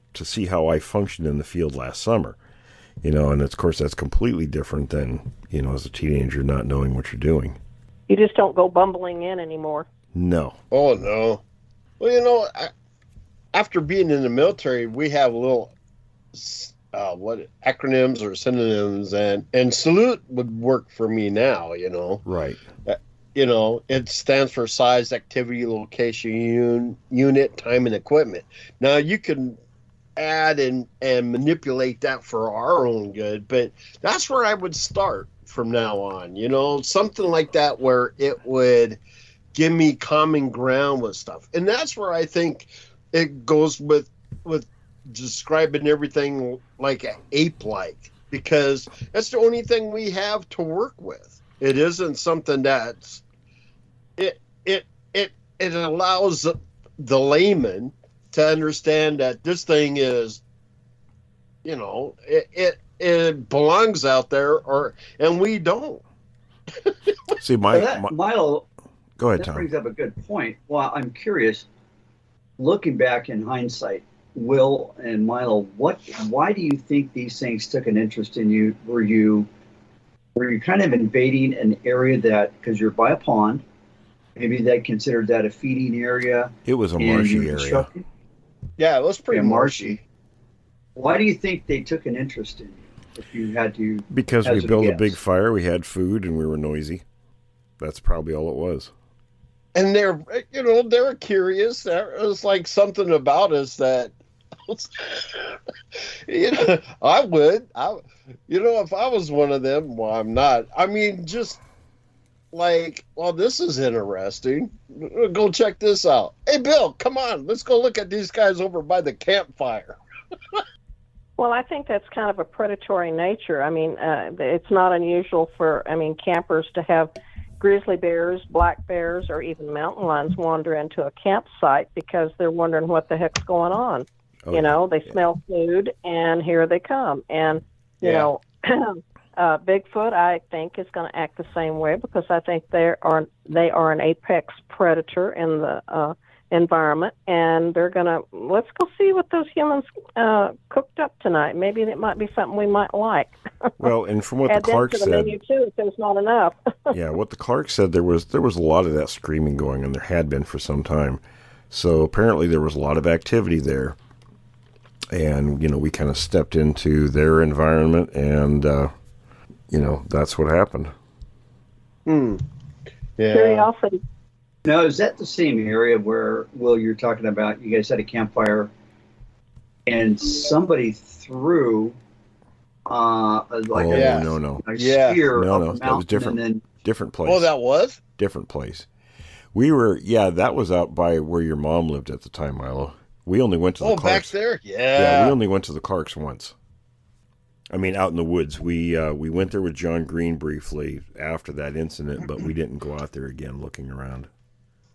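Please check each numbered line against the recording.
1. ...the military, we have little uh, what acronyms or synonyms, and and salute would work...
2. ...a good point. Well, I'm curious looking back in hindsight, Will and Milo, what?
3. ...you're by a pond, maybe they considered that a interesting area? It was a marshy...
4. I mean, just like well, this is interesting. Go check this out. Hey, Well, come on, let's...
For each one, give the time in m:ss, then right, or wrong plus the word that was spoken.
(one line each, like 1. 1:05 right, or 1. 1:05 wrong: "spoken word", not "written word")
1. 0:14 right
2. 1:09 right
3. 1:22 wrong: "feeding", not "interesting"
4. 1:50 wrong: "Bill", not "Well".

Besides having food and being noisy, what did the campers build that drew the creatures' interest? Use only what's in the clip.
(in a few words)
a big fire.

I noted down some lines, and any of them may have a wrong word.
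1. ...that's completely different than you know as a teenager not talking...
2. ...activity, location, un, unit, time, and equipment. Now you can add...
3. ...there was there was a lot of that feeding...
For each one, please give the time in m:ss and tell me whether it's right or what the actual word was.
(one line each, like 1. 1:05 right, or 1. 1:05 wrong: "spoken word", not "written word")
1. 0:03 wrong: "knowing", not "talking"
2. 0:25 right
3. 2:37 wrong: "screaming", not "feeding".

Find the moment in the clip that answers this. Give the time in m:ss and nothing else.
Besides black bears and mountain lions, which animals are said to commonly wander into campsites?
2:07.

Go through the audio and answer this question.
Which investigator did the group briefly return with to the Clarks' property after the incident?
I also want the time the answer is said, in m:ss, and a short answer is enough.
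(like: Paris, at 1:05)
John Green, at 3:19.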